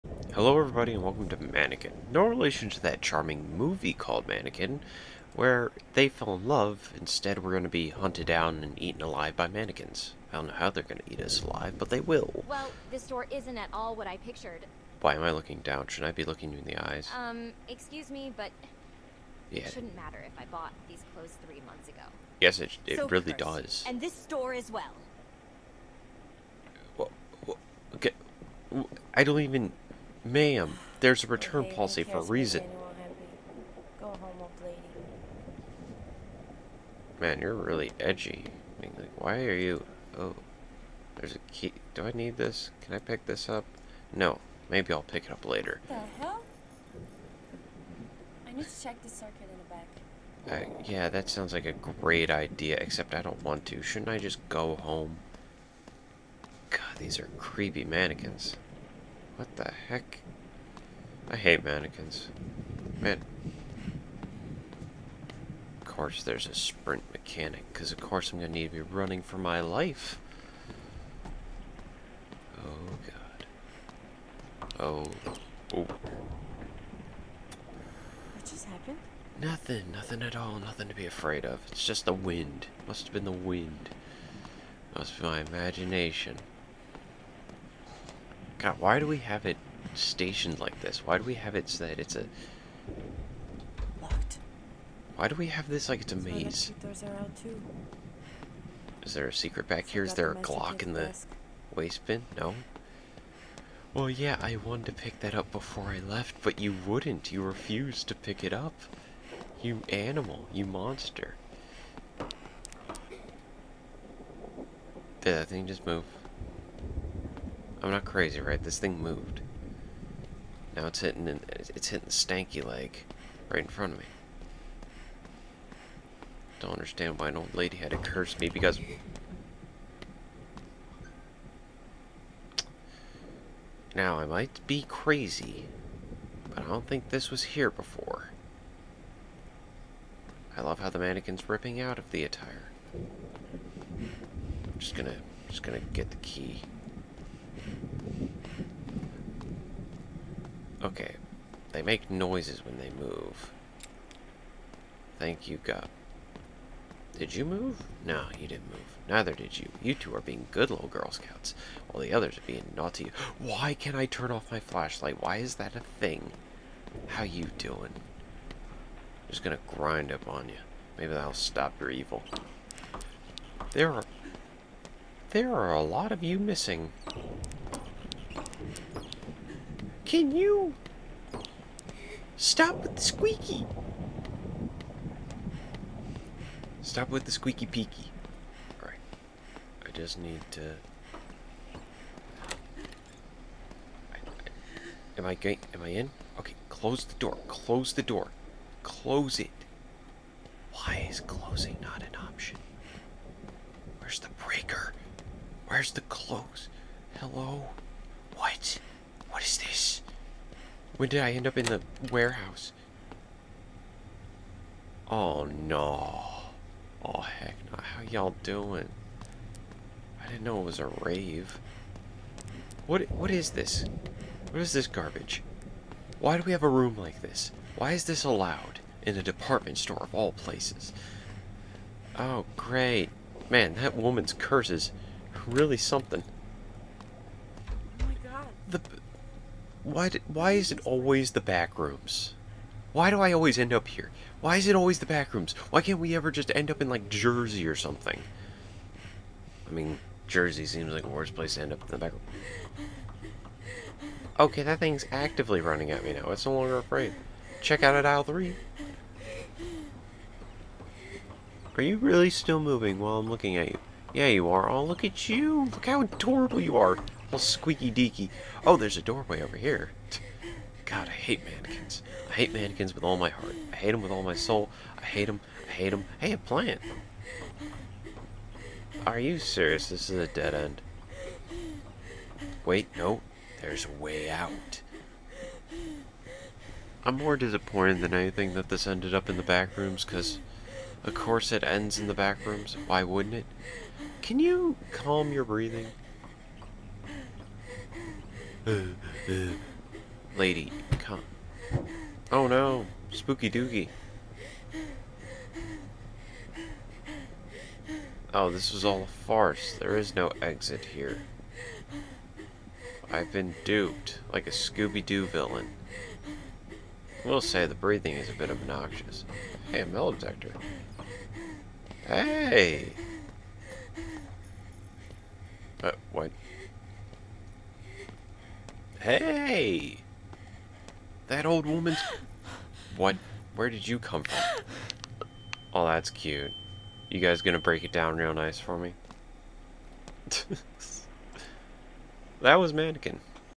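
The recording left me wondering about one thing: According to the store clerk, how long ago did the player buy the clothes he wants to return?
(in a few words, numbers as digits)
3 months ago.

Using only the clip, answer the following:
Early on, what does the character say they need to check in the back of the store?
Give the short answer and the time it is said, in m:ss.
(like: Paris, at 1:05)
The circuit, at 0:49.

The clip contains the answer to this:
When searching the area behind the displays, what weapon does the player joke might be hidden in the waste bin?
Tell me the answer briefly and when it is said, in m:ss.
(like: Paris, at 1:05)
A Glock, at 1:40.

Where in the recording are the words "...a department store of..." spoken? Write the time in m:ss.
3:49.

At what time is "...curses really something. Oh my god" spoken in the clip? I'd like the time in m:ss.
3:54.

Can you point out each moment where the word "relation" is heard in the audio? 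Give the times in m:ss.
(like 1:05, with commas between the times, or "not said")
0:02.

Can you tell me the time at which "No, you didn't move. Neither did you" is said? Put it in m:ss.
2:38.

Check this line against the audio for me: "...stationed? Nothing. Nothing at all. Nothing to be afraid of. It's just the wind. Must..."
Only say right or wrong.
wrong.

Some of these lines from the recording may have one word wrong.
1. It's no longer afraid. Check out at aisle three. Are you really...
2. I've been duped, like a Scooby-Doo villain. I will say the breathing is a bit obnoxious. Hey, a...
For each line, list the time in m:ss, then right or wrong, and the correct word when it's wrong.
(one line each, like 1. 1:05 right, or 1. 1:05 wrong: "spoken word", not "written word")
1. 4:16 right
2. 5:13 right.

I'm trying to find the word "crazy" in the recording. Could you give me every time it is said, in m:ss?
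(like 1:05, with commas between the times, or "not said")
1:58, 2:14.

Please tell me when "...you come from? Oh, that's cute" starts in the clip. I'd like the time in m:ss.
5:33.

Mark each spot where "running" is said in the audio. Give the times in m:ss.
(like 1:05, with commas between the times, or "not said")
1:08, 4:15.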